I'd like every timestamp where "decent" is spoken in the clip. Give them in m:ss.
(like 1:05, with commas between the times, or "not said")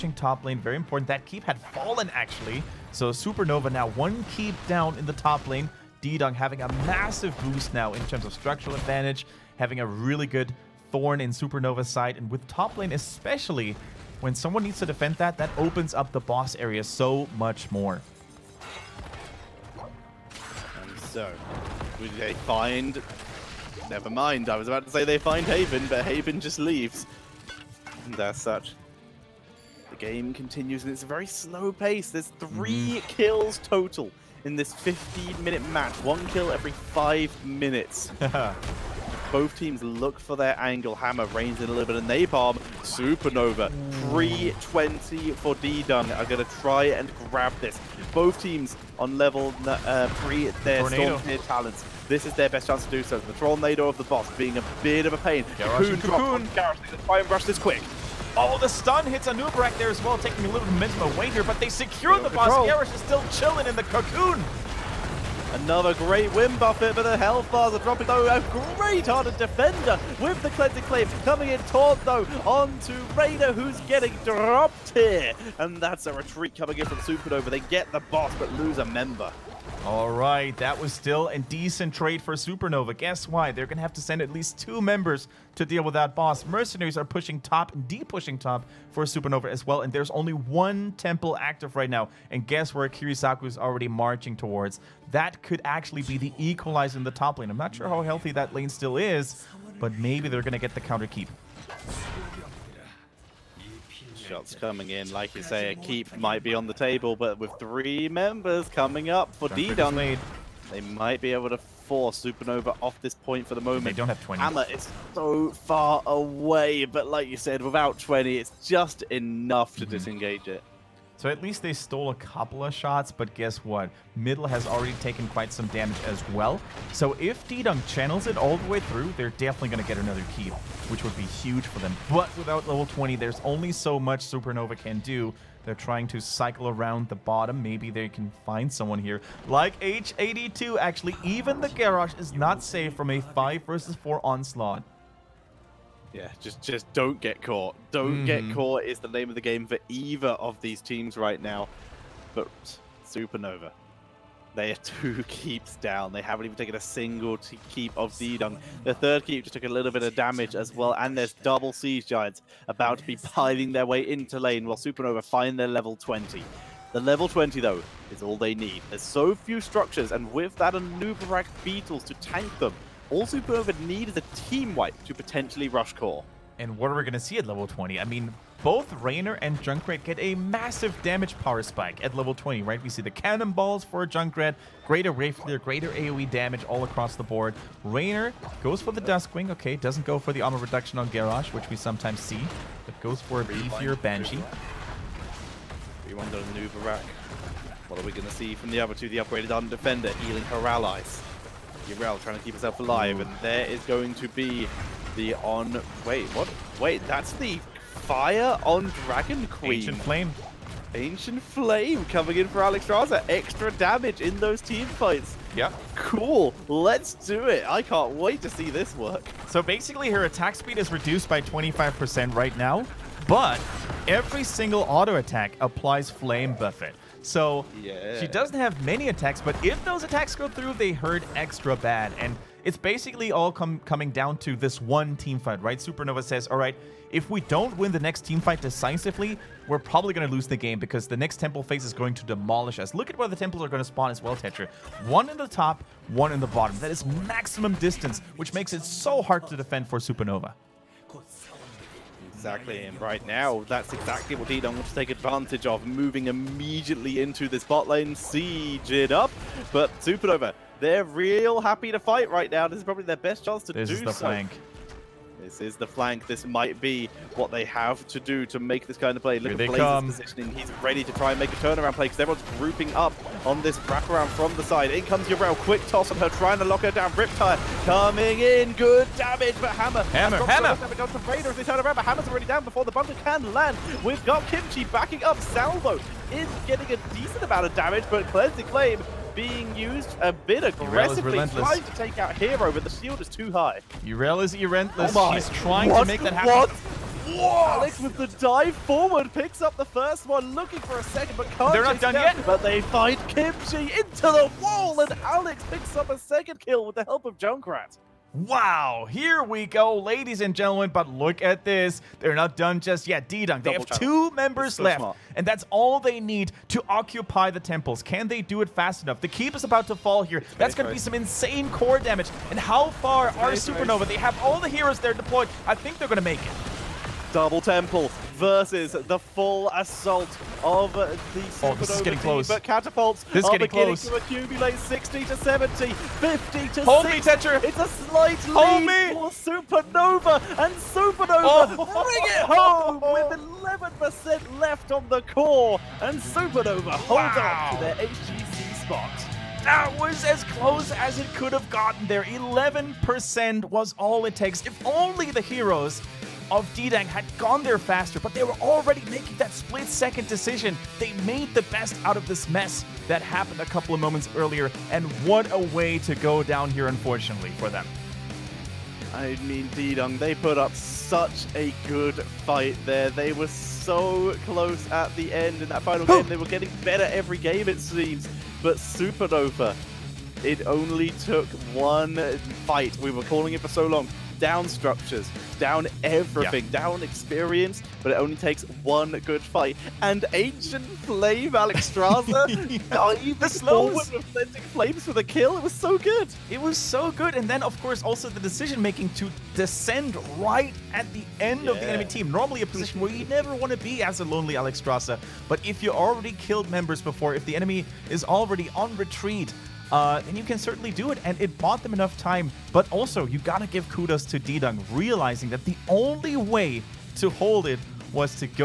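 1:21, 4:47.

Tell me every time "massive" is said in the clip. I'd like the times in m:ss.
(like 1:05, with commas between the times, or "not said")
0:06, 3:00.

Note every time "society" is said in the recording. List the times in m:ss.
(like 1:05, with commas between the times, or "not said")
not said.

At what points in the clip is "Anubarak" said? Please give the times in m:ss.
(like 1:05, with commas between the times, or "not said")
0:59, 2:50.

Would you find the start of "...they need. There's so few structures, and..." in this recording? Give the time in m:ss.
2:48.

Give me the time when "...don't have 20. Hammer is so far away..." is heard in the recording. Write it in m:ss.
1:53.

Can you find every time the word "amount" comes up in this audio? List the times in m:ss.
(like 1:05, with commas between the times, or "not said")
4:47.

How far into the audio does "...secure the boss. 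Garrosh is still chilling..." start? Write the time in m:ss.
1:01.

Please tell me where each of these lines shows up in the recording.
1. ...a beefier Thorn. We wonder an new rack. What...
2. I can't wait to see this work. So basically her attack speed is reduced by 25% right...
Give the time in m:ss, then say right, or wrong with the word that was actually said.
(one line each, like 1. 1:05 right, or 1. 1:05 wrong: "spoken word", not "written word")
1. 3:13 wrong: "Banshee", not "Thorn"
2. 3:37 right.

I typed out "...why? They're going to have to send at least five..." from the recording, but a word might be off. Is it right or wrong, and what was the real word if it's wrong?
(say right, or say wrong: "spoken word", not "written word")
wrong: "two", not "five".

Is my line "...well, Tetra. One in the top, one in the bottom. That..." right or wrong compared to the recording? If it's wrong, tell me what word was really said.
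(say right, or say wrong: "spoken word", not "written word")
right.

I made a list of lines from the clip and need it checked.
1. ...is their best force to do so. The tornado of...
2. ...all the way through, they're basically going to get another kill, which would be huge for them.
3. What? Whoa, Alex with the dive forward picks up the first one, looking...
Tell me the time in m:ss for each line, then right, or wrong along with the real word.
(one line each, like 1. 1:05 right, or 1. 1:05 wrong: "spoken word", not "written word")
1. 0:52 wrong: "chance", not "force"
2. 2:08 wrong: "definitely", not "basically"
3. 4:56 right.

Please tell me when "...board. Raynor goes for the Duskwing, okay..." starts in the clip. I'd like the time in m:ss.
3:07.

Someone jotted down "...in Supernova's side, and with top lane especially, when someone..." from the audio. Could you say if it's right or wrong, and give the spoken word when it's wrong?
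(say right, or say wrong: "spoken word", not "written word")
right.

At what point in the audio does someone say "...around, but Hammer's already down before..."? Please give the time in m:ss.
4:41.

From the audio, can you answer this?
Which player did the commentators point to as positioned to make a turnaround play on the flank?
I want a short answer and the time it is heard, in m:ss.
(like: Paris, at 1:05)
Blaze, at 4:29.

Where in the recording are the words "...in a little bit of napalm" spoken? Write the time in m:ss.
0:41.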